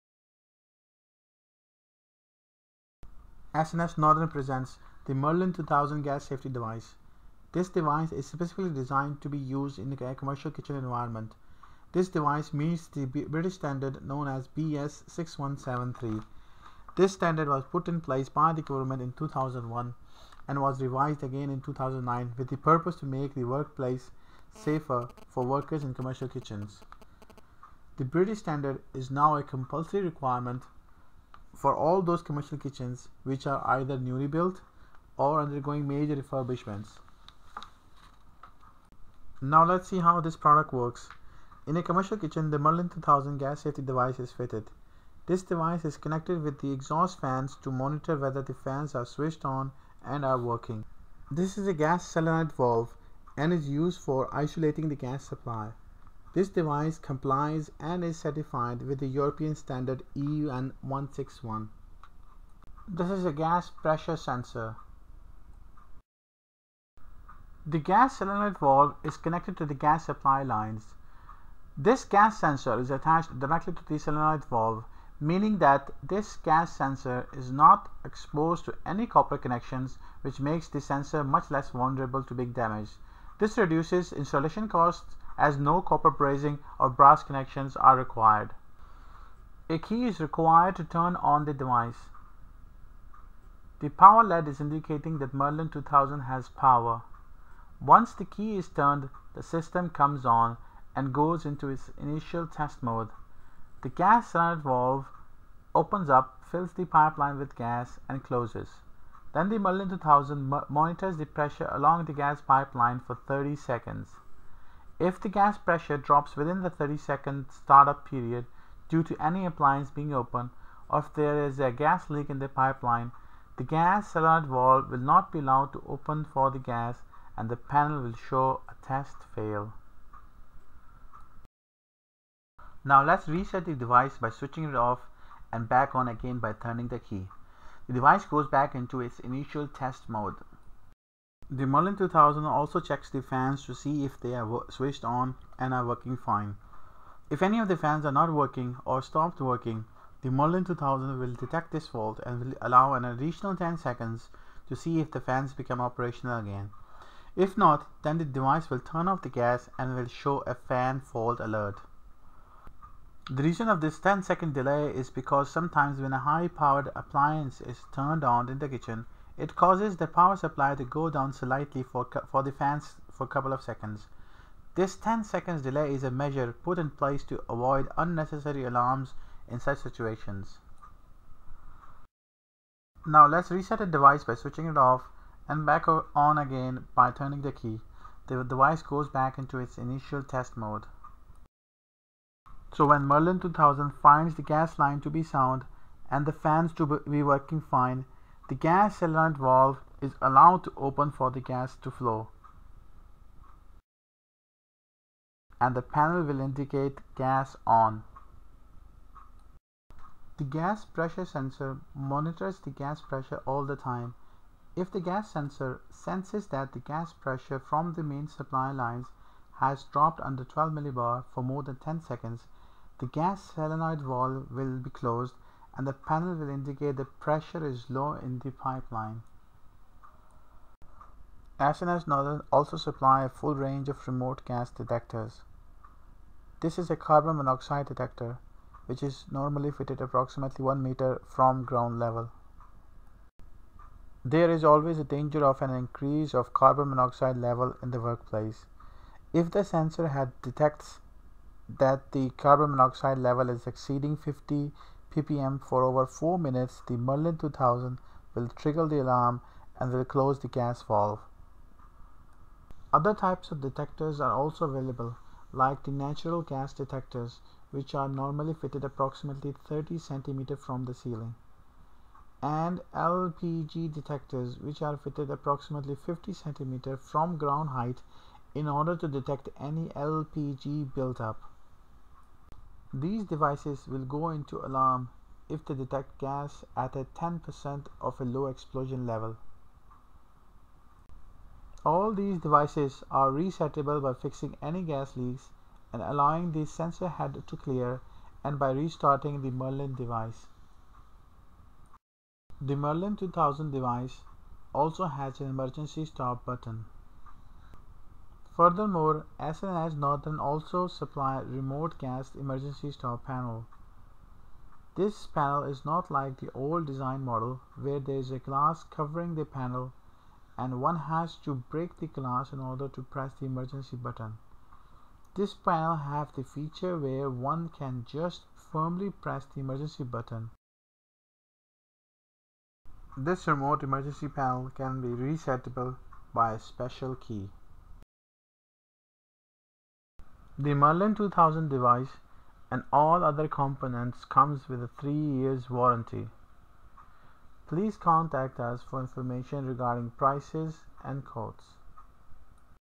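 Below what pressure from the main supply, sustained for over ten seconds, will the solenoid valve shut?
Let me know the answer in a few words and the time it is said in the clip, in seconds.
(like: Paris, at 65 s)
12 millibar, at 220 s.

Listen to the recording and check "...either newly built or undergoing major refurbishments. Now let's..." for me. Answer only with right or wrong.
right.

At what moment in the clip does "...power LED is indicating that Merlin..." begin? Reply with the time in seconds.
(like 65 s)
93 s.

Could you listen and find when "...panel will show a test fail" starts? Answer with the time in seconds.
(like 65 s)
127 s.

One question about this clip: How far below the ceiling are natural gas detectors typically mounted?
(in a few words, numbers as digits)
30 cm.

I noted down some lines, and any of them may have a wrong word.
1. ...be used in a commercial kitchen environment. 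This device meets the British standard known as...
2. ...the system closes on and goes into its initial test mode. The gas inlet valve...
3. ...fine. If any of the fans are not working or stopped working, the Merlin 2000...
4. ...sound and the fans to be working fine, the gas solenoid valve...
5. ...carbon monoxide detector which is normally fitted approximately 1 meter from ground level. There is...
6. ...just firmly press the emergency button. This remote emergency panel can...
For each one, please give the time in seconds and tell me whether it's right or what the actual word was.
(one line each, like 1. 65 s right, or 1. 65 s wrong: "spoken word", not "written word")
1. 9 s right
2. 99 s wrong: "comes", not "closes"
3. 146 s right
4. 195 s right
5. 236 s right
6. 328 s right.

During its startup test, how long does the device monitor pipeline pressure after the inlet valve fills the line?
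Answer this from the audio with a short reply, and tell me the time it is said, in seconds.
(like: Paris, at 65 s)
30 seconds, at 113 s.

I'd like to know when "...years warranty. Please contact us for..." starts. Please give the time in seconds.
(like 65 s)
345 s.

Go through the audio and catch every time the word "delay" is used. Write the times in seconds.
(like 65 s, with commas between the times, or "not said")
164 s, 175 s.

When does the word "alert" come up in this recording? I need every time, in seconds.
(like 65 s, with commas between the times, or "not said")
124 s, 161 s.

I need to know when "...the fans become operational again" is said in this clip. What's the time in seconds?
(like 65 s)
155 s.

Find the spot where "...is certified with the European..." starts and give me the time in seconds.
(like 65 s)
58 s.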